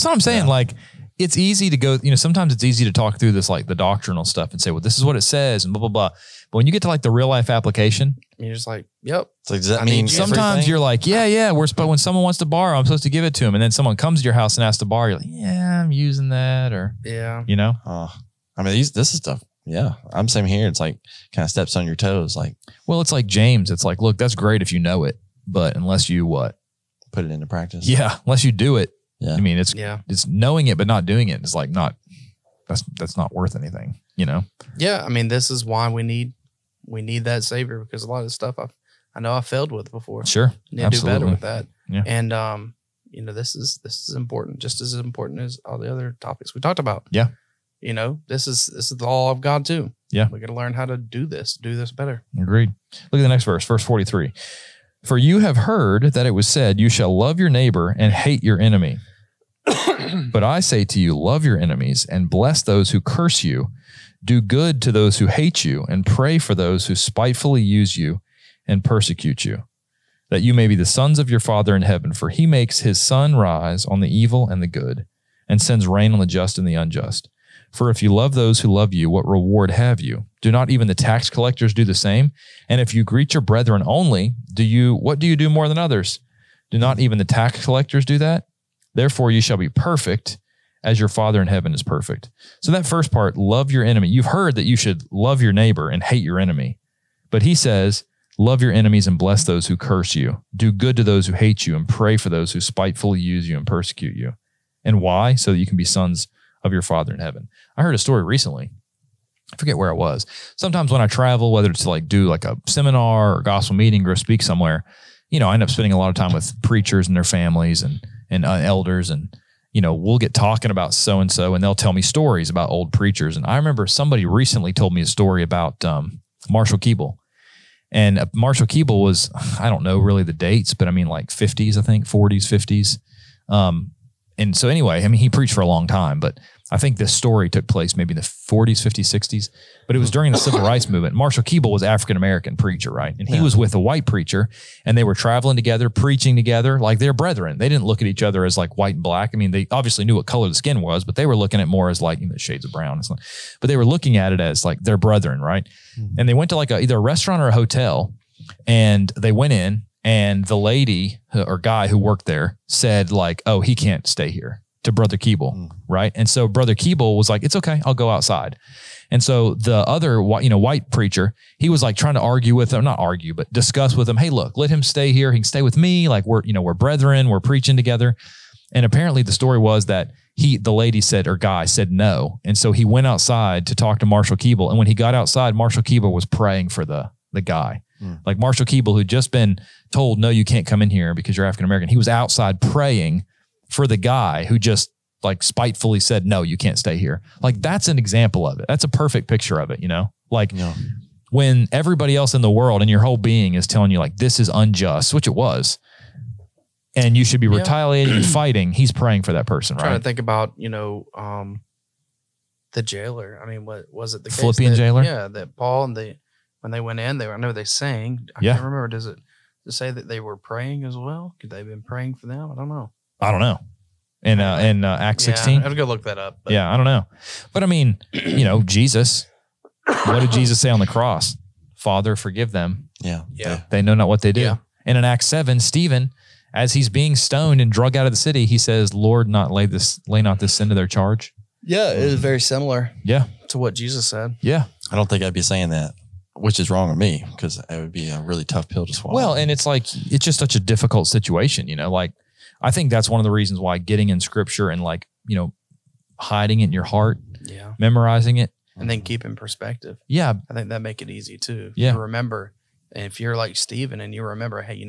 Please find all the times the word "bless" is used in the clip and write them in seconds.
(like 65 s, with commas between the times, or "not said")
62 s, 99 s.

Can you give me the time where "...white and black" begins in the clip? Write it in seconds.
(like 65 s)
148 s.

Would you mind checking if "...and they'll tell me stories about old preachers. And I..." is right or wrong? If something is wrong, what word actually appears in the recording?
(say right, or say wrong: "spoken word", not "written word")
right.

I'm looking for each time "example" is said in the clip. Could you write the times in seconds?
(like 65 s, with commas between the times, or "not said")
197 s.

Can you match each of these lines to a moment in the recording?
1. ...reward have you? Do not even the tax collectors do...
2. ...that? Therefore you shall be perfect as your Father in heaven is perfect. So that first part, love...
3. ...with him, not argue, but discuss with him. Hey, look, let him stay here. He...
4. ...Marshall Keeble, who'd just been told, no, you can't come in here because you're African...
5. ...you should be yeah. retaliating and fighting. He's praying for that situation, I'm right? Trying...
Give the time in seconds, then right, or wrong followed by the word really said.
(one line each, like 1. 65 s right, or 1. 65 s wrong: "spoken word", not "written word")
1. 79 s right
2. 88 s right
3. 172 s right
4. 188 s right
5. 207 s wrong: "person", not "situation".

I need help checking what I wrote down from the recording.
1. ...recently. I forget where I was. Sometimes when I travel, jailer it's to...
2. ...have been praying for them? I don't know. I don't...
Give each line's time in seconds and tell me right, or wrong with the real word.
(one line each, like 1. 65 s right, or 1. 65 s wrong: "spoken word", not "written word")
1. 108 s wrong: "whether", not "jailer"
2. 221 s right.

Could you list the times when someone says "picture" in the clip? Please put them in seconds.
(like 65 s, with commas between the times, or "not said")
199 s.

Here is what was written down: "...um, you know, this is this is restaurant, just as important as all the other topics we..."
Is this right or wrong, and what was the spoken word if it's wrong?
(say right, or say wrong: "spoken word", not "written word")
wrong: "important", not "restaurant".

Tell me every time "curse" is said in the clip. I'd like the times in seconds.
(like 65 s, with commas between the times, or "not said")
63 s, 99 s.